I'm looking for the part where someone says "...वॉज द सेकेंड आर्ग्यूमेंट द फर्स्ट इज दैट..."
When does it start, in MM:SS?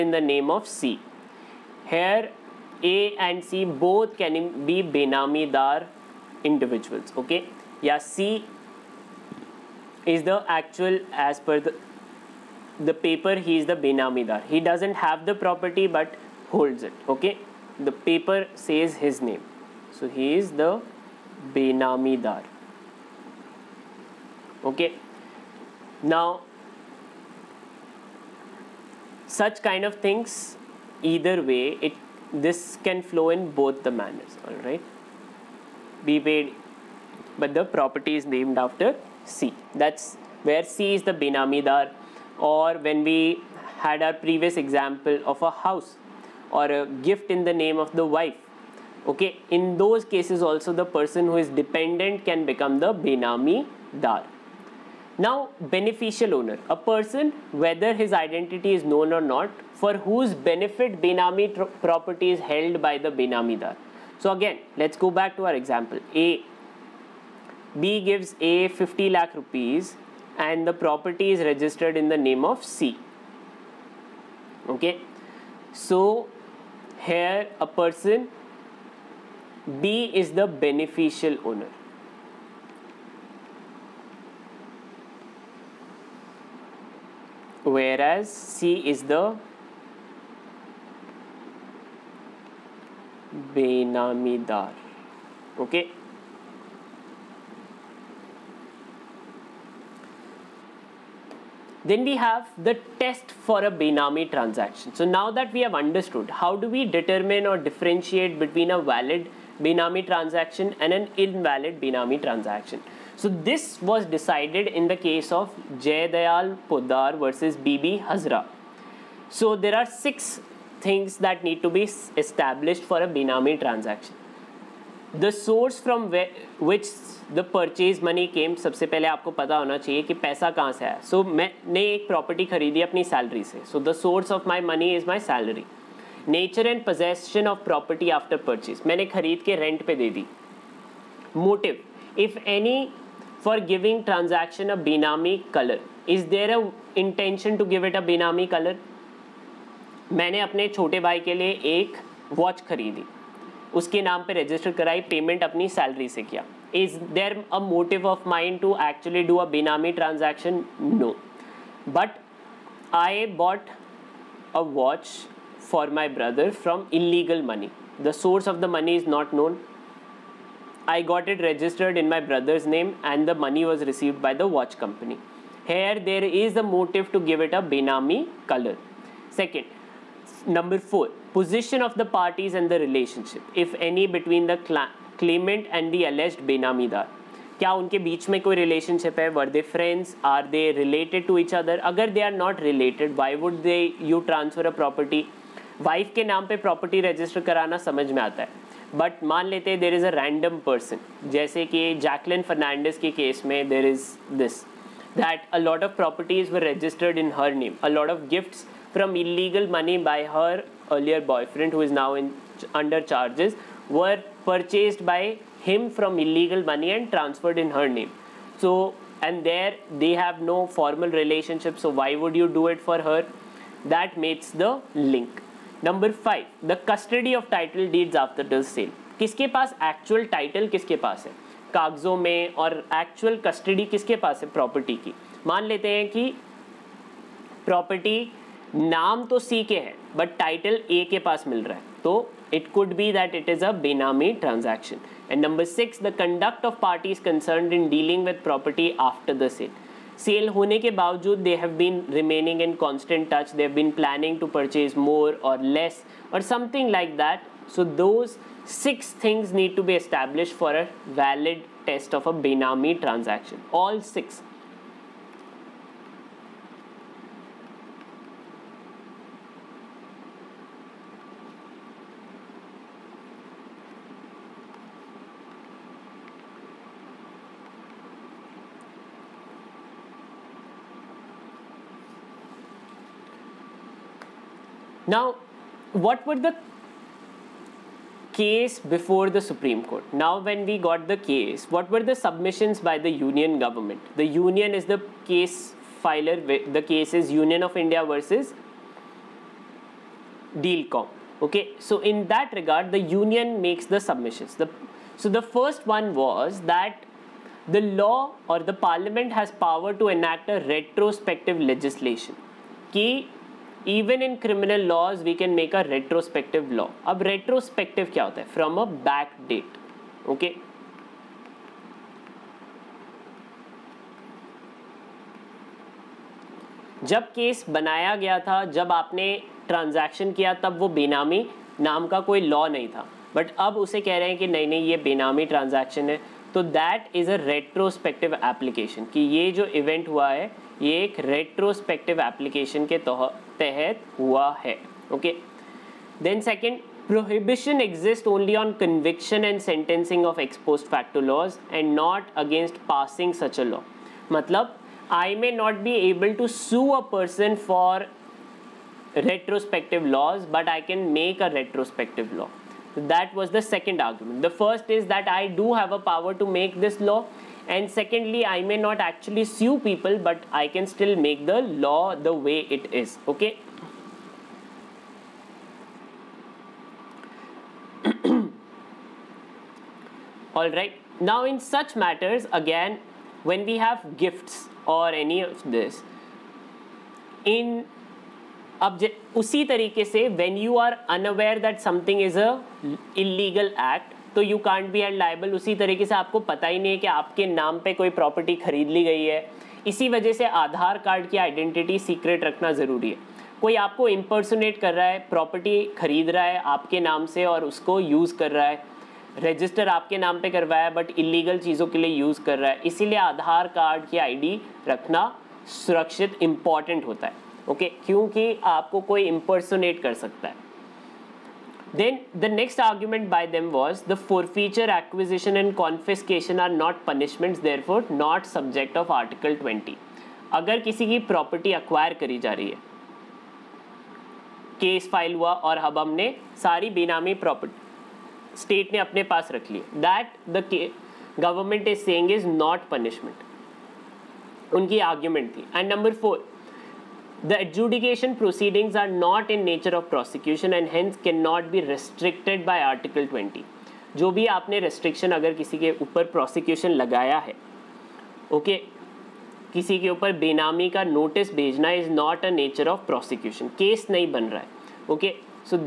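06:03.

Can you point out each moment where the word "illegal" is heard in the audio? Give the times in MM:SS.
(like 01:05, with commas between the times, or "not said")
03:29, 03:36, 06:33.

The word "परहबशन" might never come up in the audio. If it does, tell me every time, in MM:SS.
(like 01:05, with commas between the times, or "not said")
05:47.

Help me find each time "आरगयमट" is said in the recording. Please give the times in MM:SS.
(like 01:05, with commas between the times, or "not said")
06:04, 07:25.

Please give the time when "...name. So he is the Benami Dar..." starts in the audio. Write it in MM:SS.
00:19.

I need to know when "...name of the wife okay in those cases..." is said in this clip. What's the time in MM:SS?
00:47.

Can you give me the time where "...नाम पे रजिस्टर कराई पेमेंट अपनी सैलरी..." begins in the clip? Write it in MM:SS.
02:34.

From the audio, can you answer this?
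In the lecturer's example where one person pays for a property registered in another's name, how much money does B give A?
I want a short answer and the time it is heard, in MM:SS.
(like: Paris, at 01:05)
50 lakh rupees, at 01:08.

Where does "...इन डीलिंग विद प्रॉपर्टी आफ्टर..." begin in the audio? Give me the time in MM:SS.
04:07.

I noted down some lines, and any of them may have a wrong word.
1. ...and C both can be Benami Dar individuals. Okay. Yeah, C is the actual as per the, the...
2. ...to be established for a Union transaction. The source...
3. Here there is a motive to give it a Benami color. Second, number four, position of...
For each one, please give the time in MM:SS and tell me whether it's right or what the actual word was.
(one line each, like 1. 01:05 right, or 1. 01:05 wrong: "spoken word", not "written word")
1. 00:03 right
2. 02:01 wrong: "Benami", not "Union"
3. 02:55 right.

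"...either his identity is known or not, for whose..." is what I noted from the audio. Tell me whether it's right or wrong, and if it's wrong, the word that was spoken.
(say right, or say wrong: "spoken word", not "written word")
wrong: "whether", not "either".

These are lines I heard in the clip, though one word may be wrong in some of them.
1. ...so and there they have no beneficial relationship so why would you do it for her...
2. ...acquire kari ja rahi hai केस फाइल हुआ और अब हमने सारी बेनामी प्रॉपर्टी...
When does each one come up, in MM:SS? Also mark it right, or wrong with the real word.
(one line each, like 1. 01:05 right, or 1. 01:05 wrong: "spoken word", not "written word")
1. 03:38 wrong: "formal", not "beneficial"
2. 07:11 right.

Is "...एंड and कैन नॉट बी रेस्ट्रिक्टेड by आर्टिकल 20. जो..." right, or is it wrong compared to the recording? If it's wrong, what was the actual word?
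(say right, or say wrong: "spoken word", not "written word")
right.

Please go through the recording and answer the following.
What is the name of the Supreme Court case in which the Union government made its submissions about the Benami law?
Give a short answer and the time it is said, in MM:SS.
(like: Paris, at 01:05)
Union of India versus Dealcom, at 04:57.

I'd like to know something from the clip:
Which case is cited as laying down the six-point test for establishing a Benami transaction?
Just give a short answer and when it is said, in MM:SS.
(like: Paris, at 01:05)
Jay Dayal Poddar versus Bibi Hazra, at 01:55.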